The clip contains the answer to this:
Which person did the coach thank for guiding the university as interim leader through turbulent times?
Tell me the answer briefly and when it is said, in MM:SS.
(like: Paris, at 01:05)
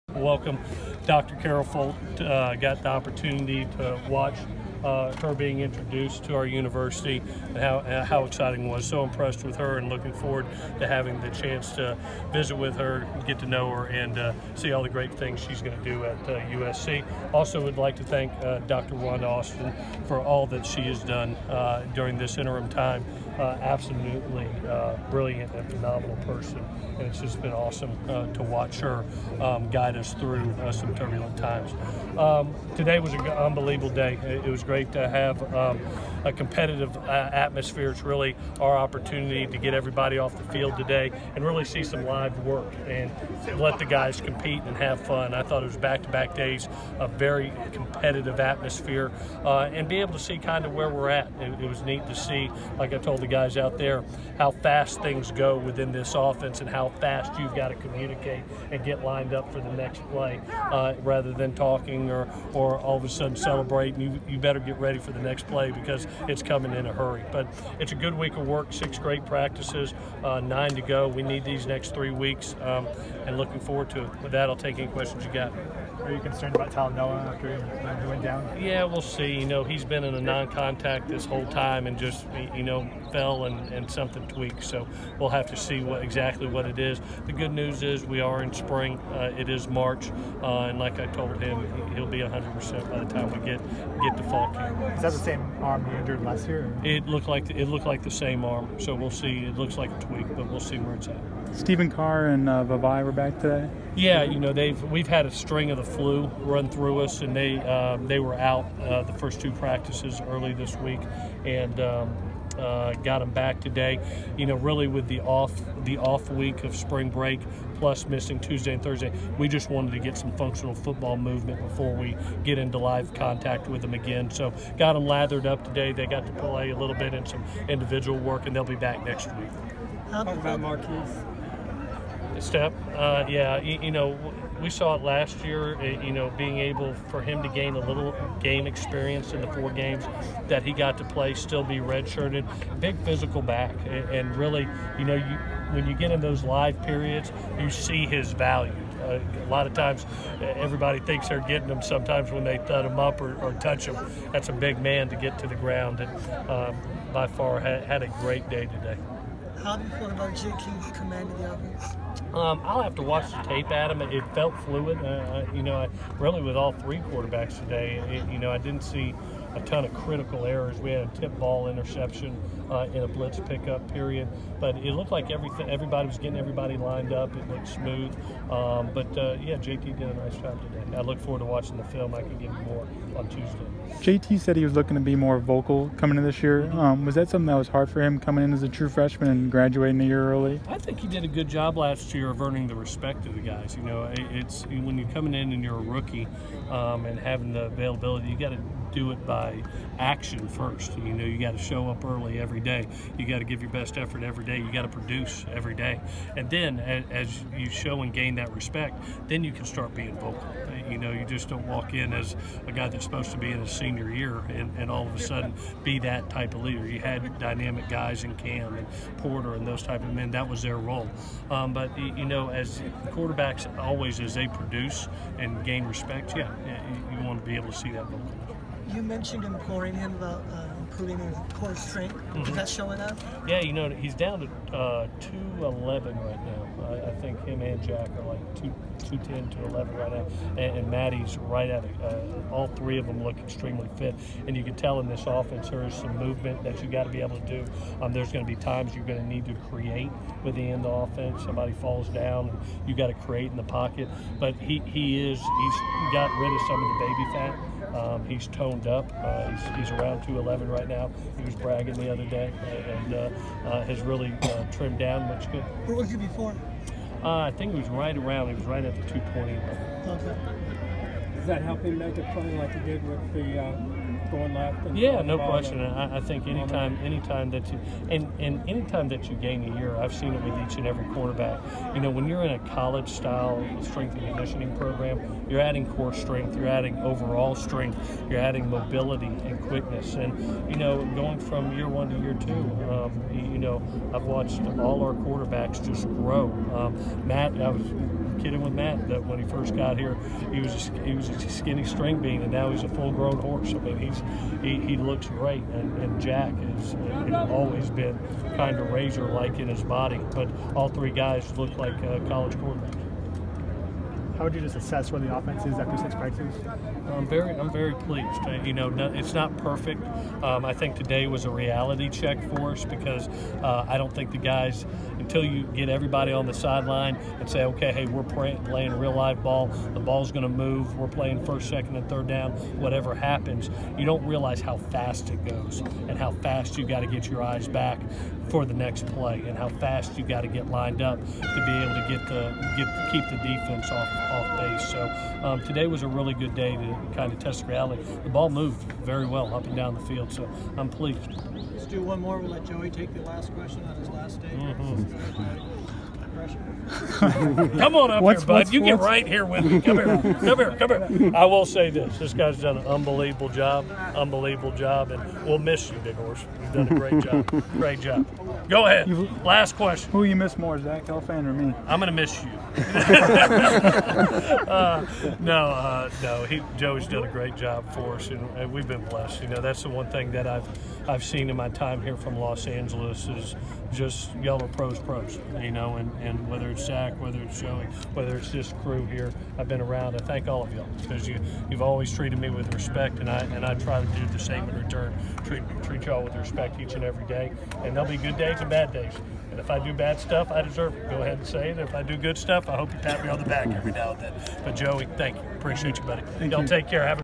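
Wanda Austin, at 00:18.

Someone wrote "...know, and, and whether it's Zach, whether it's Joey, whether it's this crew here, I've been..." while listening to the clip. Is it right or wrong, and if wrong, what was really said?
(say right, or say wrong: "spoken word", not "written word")
right.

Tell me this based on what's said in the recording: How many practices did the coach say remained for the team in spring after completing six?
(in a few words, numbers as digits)
9.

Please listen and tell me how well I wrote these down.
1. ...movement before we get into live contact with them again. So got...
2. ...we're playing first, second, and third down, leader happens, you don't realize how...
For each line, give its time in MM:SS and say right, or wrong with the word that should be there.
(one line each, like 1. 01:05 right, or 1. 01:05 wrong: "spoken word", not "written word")
1. 02:01 right
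2. 05:30 wrong: "whatever", not "leader".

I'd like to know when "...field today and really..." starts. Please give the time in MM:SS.
00:40.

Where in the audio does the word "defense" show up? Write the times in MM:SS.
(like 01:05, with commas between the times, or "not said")
05:43.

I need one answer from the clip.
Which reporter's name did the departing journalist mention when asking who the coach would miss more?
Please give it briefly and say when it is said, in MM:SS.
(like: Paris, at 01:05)
Zach Helfand, at 06:10.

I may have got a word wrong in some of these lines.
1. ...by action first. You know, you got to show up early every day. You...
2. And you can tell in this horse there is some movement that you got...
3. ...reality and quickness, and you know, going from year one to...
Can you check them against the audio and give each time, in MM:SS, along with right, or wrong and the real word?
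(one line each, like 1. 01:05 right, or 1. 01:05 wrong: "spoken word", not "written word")
1. 03:19 right
2. 04:04 wrong: "offense", not "horse"
3. 04:48 wrong: "mobility", not "reality".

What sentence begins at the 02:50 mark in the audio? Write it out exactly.
We had a tip ball interception uh, in a blitz pickup period, but it looked like everything.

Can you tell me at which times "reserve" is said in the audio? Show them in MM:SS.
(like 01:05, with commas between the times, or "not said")
not said.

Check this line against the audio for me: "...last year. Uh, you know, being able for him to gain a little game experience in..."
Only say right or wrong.
right.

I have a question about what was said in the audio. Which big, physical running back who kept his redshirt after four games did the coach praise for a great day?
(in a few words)
Markese Stepp.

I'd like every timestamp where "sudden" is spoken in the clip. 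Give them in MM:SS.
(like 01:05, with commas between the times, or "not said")
01:03, 03:35.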